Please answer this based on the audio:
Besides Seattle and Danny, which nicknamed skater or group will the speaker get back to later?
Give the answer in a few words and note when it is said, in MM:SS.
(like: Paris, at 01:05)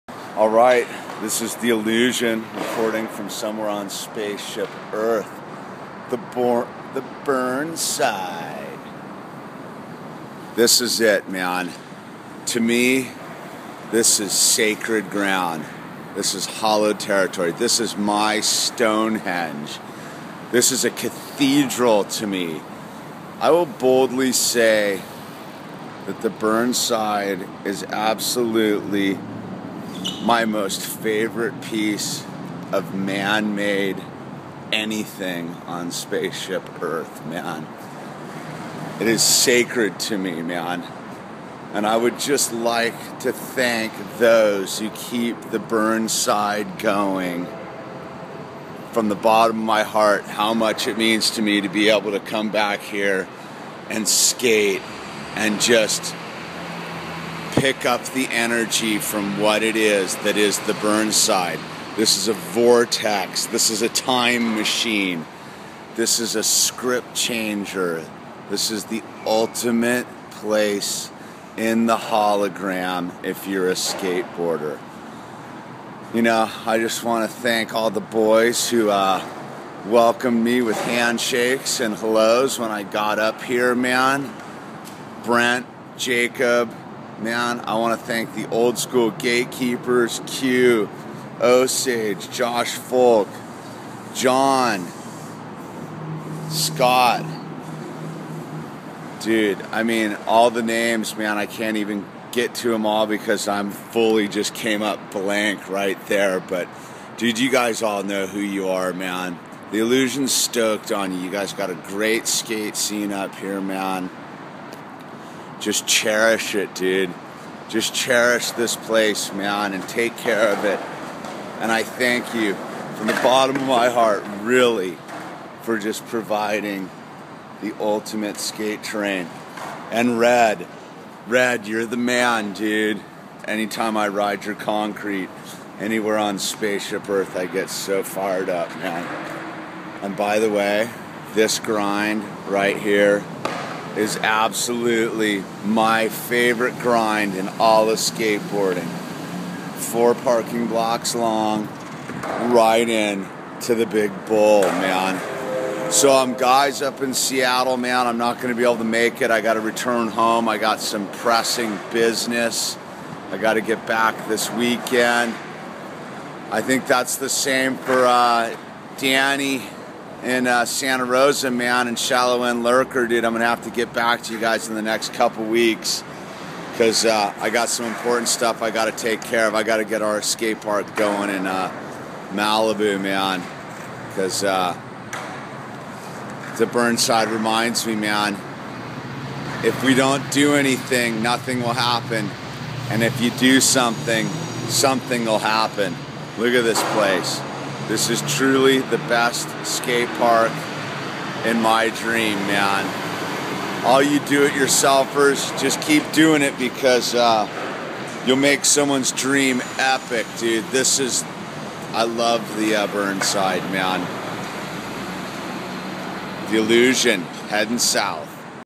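Shallow End Lurker, at 02:51.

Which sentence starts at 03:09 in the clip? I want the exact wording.
If we don't do anything, nothing will happen, and if you do something, something will happen.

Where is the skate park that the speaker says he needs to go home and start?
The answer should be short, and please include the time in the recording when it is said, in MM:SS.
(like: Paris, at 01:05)
Malibu, at 03:02.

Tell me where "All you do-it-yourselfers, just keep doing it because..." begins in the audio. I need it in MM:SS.
03:23.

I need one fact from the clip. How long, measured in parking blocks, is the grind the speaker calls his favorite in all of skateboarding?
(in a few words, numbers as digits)
4 parking blocks.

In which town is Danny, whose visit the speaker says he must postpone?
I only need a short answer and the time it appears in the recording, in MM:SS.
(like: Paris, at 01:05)
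Santa Rosa, at 02:50.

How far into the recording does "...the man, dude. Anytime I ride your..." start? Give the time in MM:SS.
02:11.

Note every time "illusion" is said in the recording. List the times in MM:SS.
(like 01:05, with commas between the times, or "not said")
00:01, 01:49, 03:36.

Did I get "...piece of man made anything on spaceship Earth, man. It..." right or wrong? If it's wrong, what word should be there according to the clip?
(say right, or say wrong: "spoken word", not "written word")
right.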